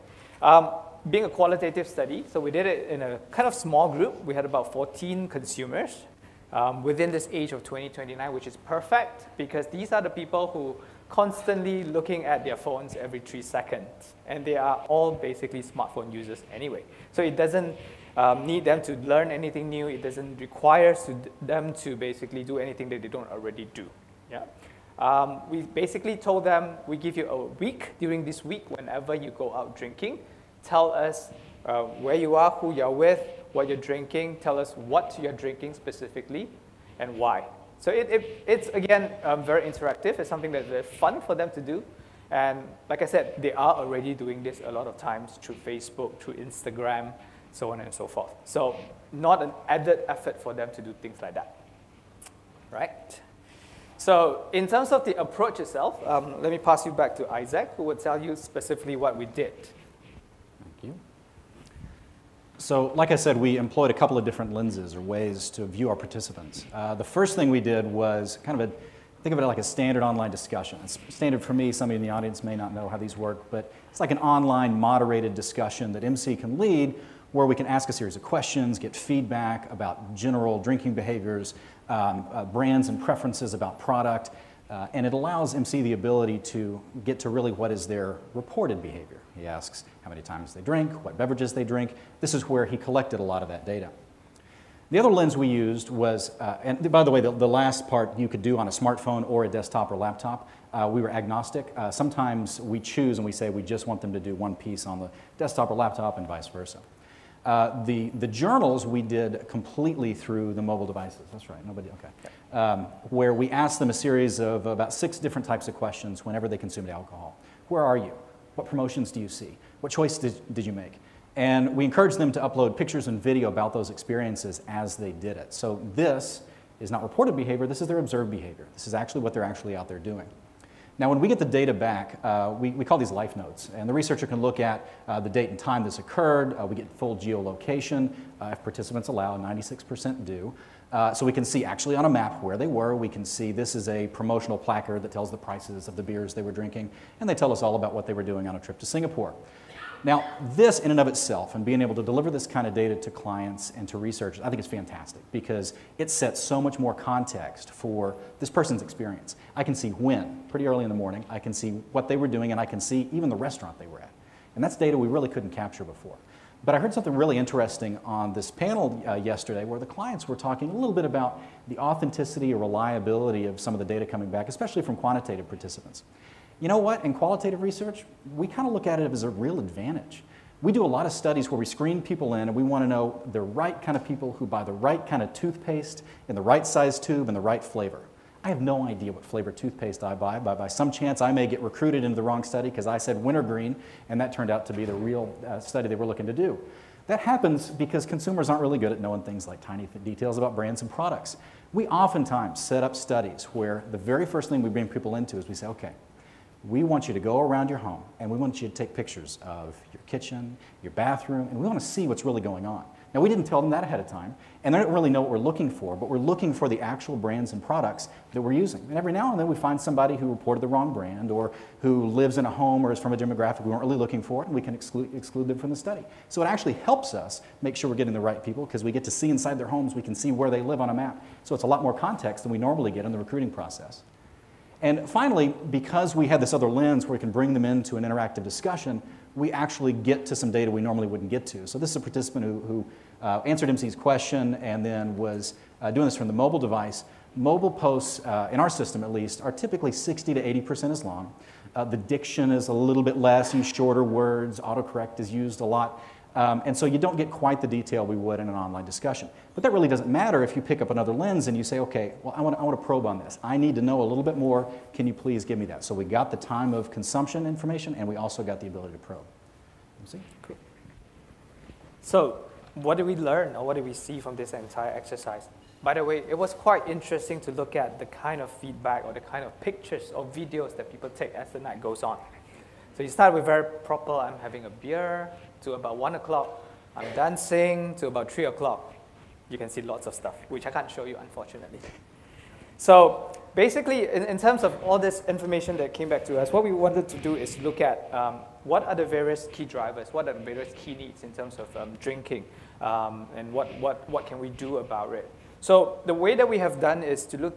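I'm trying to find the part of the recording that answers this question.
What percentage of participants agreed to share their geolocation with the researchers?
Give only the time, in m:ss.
2:19.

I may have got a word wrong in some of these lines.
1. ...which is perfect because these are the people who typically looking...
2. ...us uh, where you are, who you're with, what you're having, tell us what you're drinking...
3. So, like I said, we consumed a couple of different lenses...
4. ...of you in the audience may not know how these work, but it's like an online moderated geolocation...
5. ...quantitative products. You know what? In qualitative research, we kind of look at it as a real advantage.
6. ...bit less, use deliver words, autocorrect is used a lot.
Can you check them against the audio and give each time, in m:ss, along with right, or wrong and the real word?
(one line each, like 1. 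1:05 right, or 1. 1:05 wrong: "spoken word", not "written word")
1. 0:08 wrong: "constantly", not "typically"
2. 0:30 wrong: "drinking", not "having"
3. 1:02 wrong: "employed", not "consumed"
4. 1:11 wrong: "discussion", not "geolocation"
5. 2:54 wrong: "participants", not "products"
6. 4:13 wrong: "shorter", not "deliver".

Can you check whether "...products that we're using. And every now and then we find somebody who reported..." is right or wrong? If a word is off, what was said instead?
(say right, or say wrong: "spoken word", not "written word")
right.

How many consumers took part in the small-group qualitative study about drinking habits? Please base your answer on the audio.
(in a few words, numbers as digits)
14.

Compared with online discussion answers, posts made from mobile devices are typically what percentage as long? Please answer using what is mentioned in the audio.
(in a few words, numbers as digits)
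60 to 80%.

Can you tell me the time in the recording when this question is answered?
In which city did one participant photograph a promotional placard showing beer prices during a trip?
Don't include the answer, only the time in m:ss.
2:28.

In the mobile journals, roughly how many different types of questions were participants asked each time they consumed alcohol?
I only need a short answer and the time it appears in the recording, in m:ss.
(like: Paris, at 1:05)
6, at 1:54.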